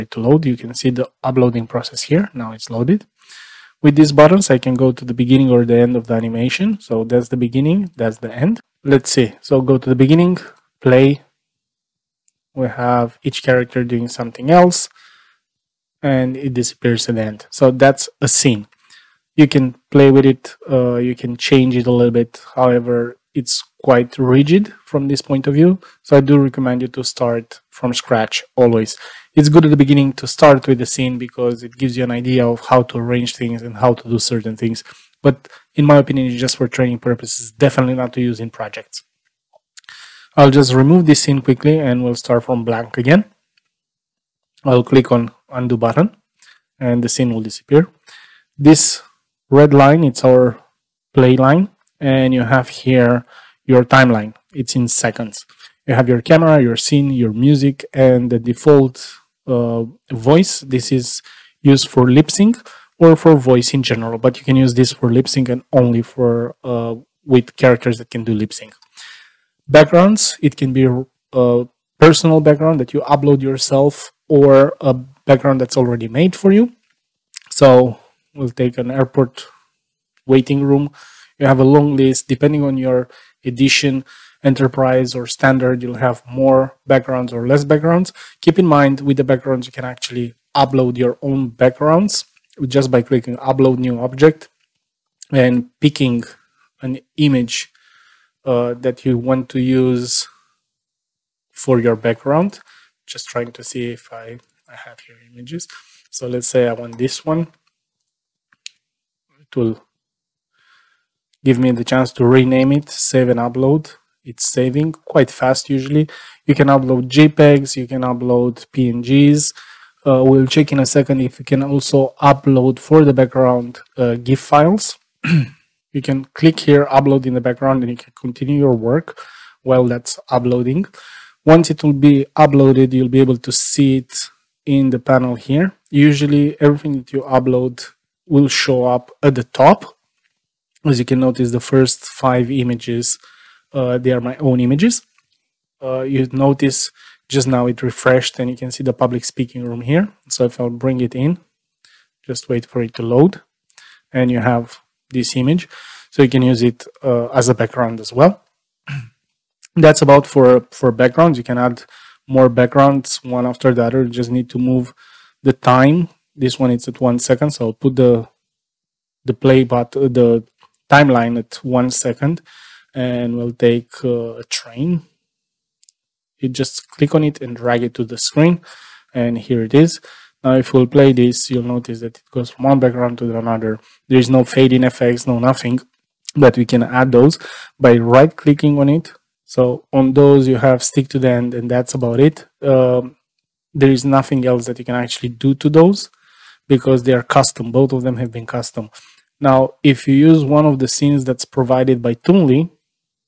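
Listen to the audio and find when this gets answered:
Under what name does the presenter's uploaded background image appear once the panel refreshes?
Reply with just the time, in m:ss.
2:28.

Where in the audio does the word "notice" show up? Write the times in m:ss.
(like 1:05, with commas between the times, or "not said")
2:21, 2:26, 3:01.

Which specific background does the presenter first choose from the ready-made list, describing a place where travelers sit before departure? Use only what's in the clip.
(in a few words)
Airport waiting room.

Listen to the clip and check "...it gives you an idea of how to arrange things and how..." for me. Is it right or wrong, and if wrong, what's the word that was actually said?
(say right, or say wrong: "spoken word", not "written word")
right.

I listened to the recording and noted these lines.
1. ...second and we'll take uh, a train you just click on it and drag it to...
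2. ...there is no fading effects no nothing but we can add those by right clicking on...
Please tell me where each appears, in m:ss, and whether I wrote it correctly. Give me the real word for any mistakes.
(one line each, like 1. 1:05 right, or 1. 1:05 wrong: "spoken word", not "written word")
1. 2:51 right
2. 3:04 right.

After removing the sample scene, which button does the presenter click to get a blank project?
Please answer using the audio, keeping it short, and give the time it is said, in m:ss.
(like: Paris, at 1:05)
Undo, at 0:45.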